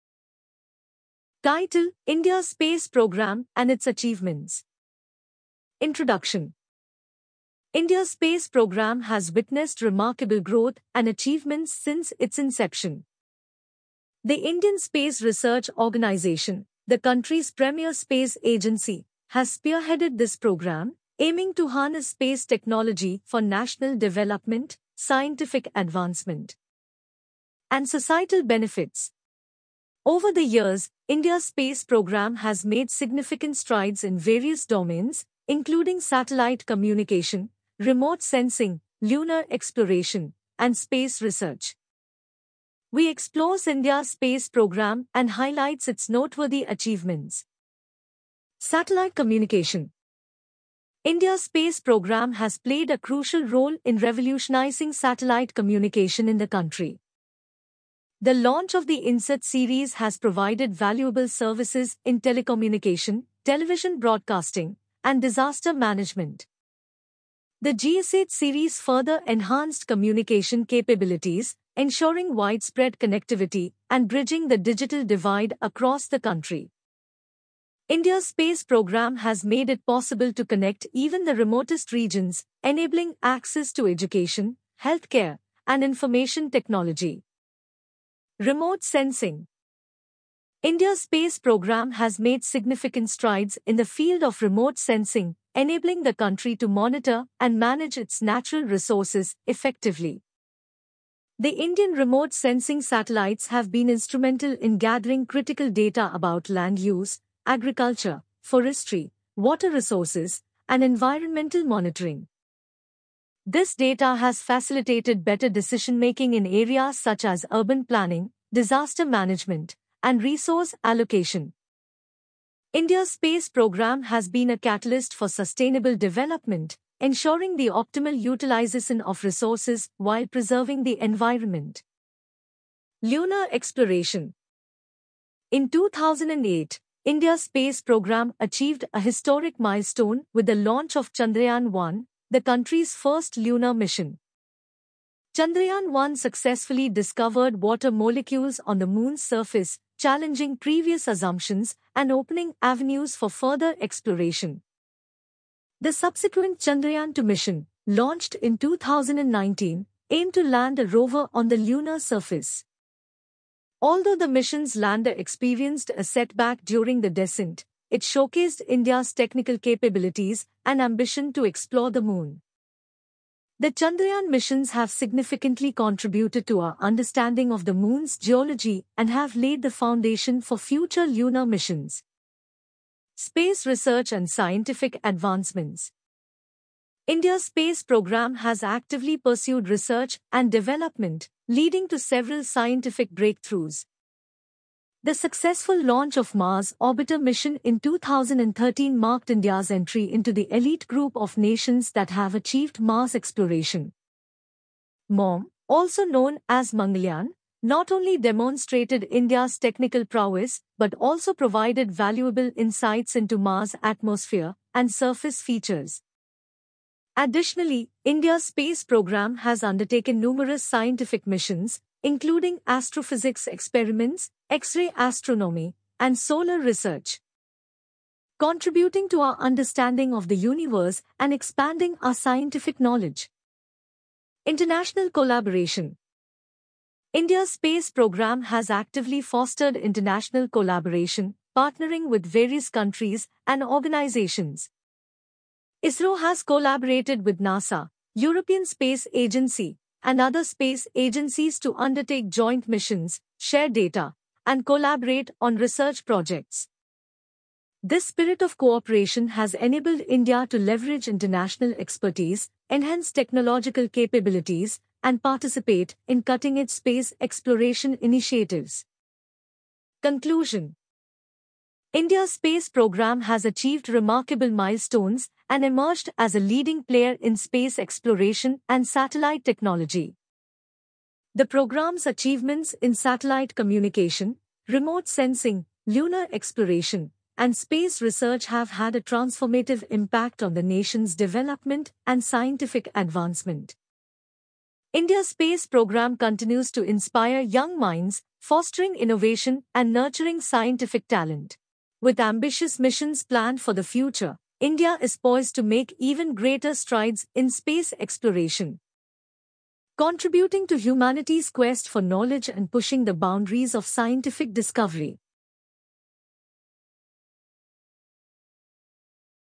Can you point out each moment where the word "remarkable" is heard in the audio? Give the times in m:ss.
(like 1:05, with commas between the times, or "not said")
0:09, 4:33.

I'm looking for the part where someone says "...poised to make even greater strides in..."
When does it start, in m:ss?
5:05.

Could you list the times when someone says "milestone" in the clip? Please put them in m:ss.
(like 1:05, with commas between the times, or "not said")
2:19, 4:34.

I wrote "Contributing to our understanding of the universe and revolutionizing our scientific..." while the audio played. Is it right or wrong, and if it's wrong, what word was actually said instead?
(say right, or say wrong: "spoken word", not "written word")
wrong: "expanding", not "revolutionizing".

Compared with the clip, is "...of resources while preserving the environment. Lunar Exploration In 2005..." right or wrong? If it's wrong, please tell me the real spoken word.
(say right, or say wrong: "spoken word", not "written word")
wrong: "2008", not "2005".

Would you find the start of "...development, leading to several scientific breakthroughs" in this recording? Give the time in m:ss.
3:10.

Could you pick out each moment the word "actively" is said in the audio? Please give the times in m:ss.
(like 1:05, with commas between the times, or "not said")
3:08, 3:58.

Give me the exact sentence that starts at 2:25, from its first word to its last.
Chandrayaan 1 successfully discovered water molecules on the moon's surface, challenging previous assumptions and opening avenues for further exploration.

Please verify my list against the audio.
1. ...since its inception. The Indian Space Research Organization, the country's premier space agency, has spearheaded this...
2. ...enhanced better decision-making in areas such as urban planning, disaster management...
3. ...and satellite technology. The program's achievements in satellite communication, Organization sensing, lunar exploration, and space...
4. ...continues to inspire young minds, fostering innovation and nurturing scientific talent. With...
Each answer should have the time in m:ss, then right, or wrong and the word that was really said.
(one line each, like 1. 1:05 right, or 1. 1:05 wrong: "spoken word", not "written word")
1. 0:11 right
2. 1:54 wrong: "facilitated", not "enhanced"
3. 4:38 wrong: "Remote", not "Organization"
4. 4:56 right.